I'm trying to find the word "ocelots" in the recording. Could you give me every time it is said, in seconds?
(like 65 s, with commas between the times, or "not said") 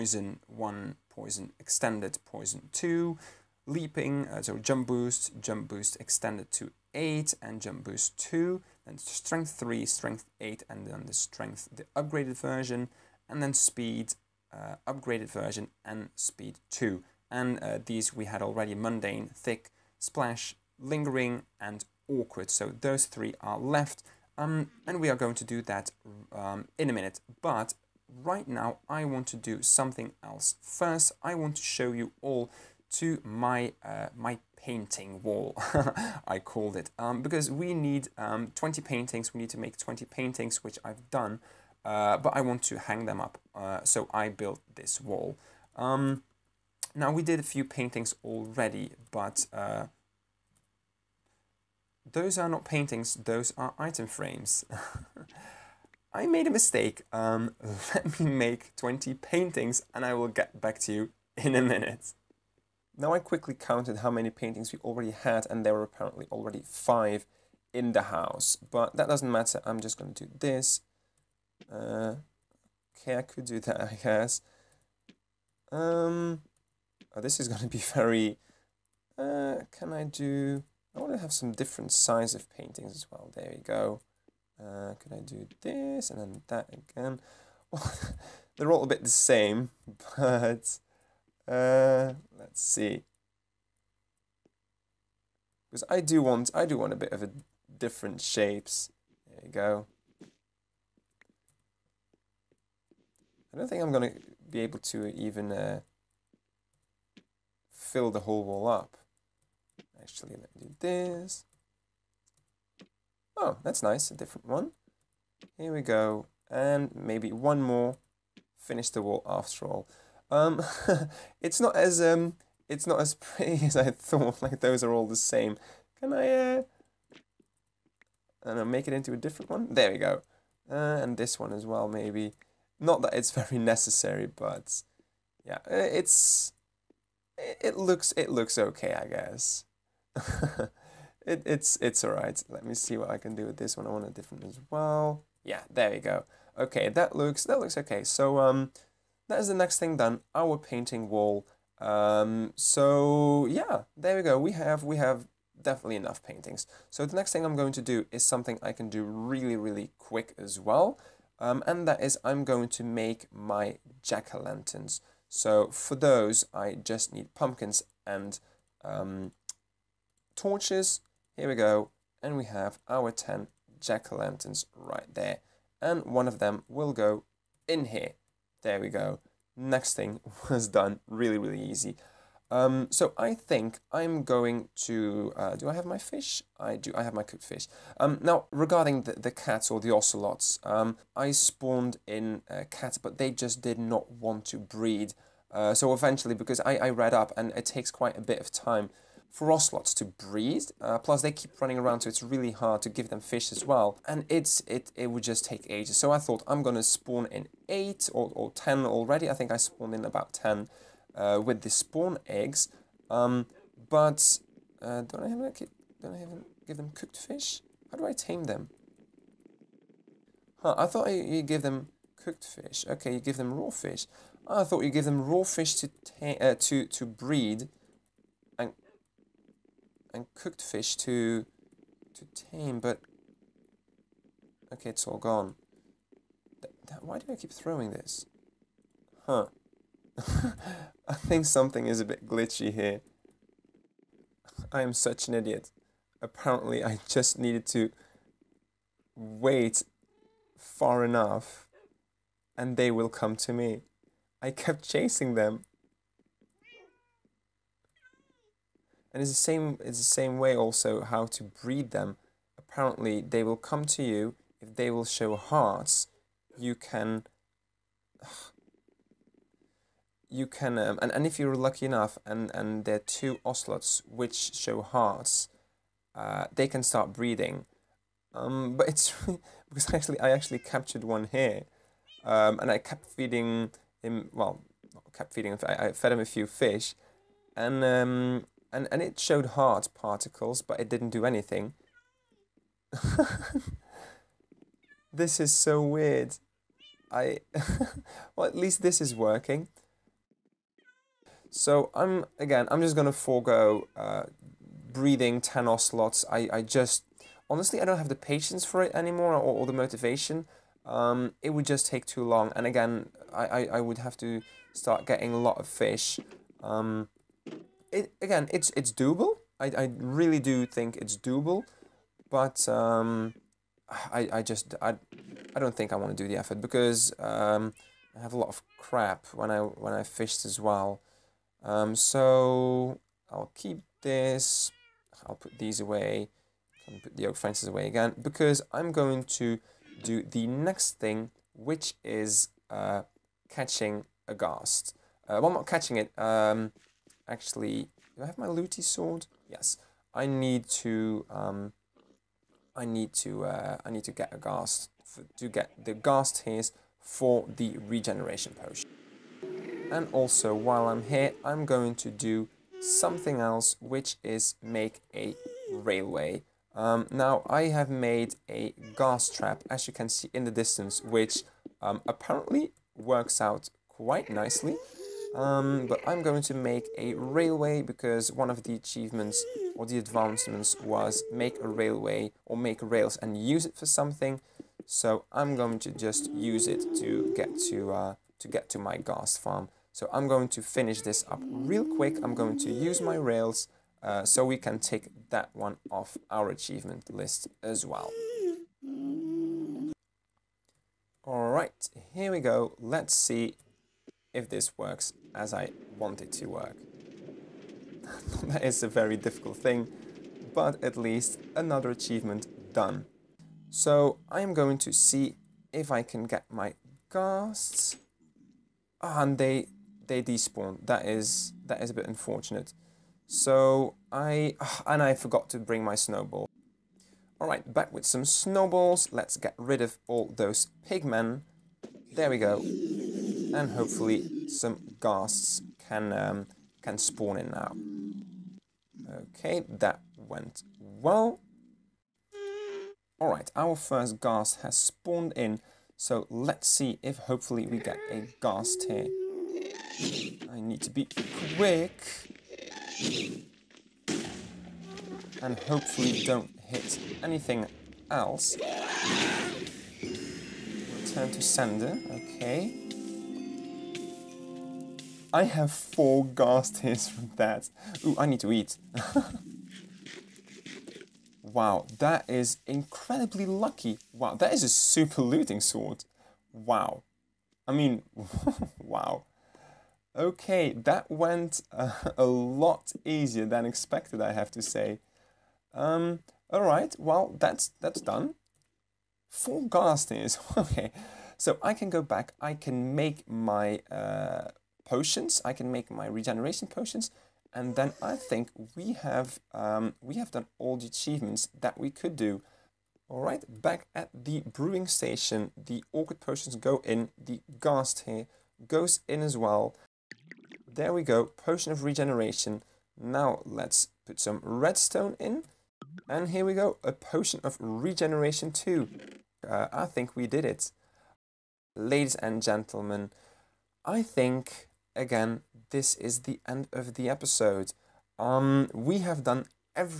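189 s, 199 s, 273 s.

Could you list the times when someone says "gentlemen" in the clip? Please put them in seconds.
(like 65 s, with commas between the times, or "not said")
522 s.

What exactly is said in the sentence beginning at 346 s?
Um, actually, do I have my Looting sword?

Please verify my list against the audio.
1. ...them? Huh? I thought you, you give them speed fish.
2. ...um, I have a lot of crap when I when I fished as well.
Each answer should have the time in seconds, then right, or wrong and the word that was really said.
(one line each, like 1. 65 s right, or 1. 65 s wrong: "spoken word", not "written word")
1. 218 s wrong: "cooked", not "speed"
2. 327 s right.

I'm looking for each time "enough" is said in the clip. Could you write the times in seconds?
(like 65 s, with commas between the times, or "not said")
155 s, 251 s, 271 s.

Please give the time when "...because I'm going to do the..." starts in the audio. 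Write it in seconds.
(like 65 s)
338 s.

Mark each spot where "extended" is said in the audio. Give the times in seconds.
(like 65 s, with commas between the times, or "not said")
1 s, 5 s.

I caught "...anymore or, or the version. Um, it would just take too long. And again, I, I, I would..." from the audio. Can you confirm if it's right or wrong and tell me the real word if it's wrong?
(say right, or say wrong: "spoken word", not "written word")
wrong: "motivation", not "version".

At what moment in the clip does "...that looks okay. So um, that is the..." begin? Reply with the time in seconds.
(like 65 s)
147 s.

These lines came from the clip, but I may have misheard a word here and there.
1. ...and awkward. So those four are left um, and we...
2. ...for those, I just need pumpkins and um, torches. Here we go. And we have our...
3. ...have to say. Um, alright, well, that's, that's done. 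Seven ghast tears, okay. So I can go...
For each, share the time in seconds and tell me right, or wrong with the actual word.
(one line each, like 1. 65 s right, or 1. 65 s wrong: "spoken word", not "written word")
1. 21 s wrong: "three", not "four"
2. 165 s right
3. 484 s wrong: "Four", not "Seven".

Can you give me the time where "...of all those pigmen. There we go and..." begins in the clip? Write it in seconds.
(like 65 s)
429 s.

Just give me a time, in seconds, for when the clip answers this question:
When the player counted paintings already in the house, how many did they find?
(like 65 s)
66 s.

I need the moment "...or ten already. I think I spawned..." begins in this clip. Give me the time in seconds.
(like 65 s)
208 s.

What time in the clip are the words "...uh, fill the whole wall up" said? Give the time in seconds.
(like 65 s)
105 s.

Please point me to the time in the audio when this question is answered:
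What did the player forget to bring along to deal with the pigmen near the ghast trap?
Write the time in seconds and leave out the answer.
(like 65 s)
425 s.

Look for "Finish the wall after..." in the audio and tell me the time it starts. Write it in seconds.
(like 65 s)
118 s.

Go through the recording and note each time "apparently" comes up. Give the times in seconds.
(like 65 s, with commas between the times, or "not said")
65 s, 246 s, 262 s, 372 s.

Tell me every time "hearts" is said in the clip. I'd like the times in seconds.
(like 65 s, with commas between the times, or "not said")
265 s, 274 s.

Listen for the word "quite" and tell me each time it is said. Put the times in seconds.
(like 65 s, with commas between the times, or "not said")
197 s, 373 s.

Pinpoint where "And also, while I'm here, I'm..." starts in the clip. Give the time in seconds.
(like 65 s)
359 s.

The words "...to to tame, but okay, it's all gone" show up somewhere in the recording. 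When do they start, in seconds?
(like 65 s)
230 s.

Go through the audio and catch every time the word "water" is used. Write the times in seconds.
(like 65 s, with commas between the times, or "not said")
not said.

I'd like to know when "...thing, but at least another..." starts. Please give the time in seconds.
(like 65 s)
409 s.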